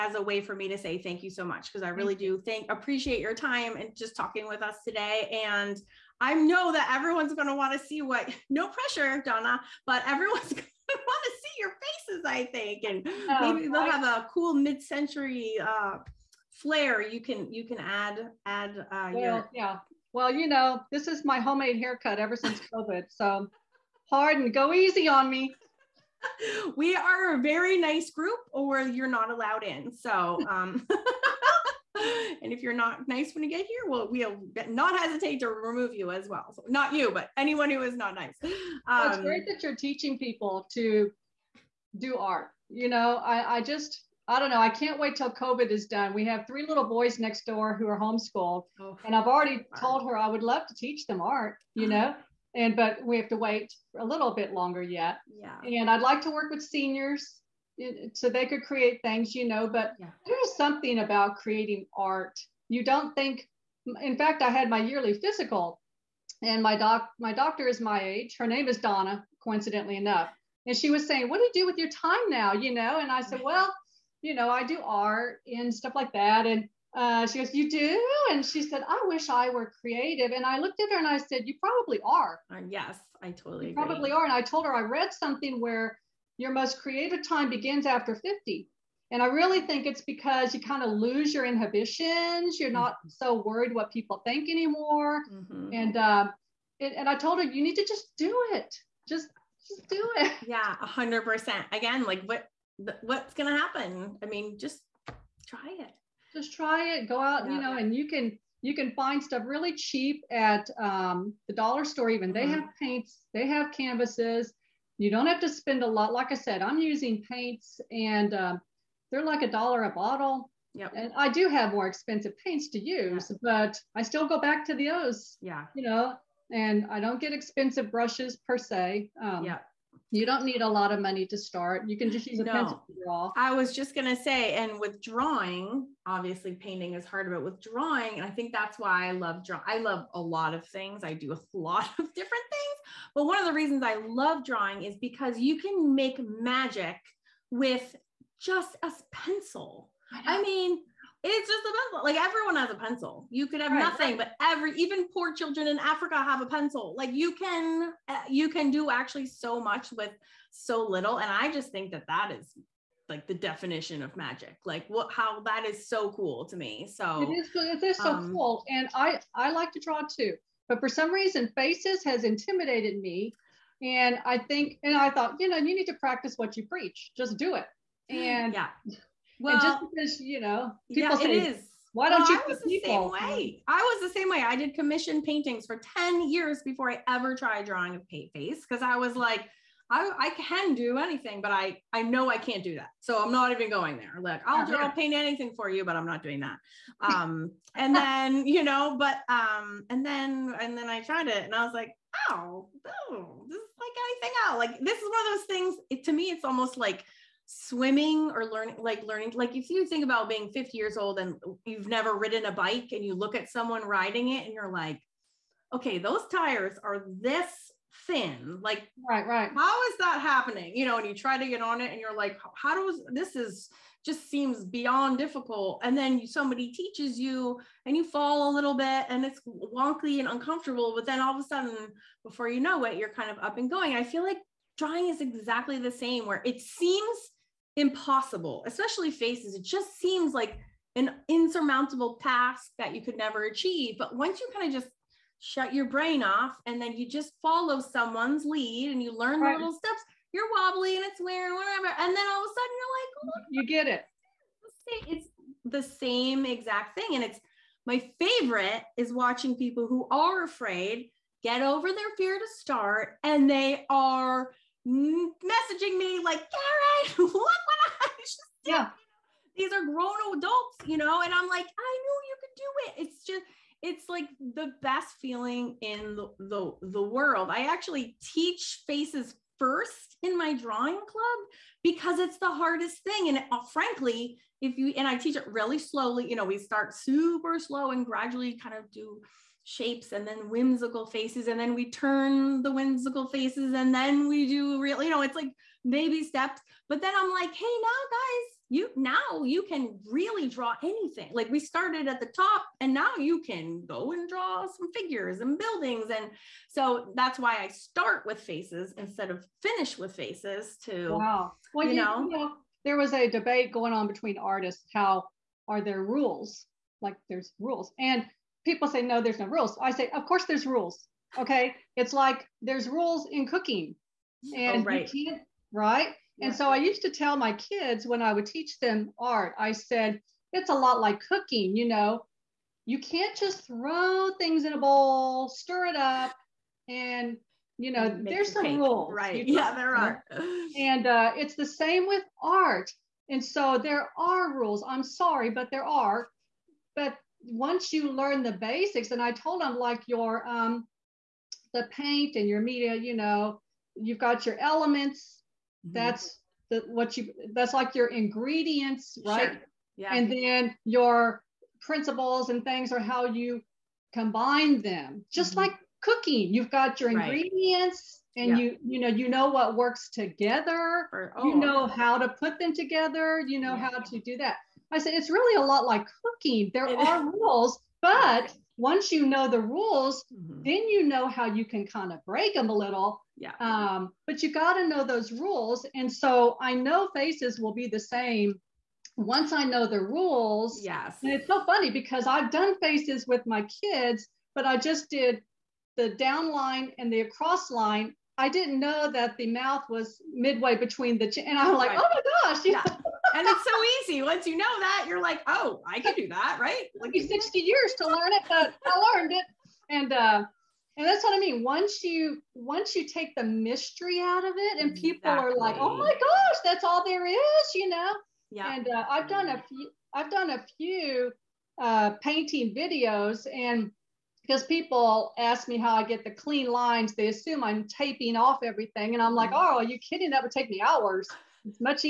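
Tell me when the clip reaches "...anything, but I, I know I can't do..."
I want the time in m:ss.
3:10.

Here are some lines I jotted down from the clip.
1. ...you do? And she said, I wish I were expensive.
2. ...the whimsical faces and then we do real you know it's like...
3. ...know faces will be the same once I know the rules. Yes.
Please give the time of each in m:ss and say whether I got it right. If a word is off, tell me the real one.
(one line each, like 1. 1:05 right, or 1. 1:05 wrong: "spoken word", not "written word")
1. 1:17 wrong: "creative", not "expensive"
2. 4:52 right
3. 6:26 right.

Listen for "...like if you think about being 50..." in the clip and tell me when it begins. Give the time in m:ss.
3:29.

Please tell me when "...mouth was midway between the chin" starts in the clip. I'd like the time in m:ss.
6:39.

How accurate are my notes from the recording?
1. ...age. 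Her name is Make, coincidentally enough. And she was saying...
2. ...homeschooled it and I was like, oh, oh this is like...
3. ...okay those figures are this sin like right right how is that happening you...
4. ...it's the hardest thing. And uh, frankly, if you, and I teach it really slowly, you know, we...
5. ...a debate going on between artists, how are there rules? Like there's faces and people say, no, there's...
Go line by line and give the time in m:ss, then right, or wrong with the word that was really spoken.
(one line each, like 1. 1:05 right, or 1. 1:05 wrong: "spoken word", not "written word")
1. 1:08 wrong: "Donna", not "Make"
2. 3:21 wrong: "tried", not "homeschooled"
3. 3:35 wrong: "tires", not "figures"
4. 4:42 right
5. 5:13 wrong: "rules", not "faces".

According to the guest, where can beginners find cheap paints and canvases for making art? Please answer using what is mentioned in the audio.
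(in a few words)
the dollar store.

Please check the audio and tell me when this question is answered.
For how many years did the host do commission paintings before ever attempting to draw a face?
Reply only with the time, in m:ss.
3:05.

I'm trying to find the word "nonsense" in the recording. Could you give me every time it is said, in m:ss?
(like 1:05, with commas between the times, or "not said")
not said.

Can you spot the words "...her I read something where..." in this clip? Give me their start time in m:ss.
1:24.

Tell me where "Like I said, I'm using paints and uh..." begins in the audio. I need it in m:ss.
1:56.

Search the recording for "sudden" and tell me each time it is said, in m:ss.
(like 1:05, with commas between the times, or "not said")
3:51, 4:12.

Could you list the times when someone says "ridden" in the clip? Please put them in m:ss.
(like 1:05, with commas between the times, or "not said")
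3:32.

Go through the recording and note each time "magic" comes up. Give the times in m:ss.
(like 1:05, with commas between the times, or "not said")
2:26, 2:44.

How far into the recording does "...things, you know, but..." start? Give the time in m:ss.
0:59.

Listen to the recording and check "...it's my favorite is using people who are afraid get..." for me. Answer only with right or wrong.
wrong.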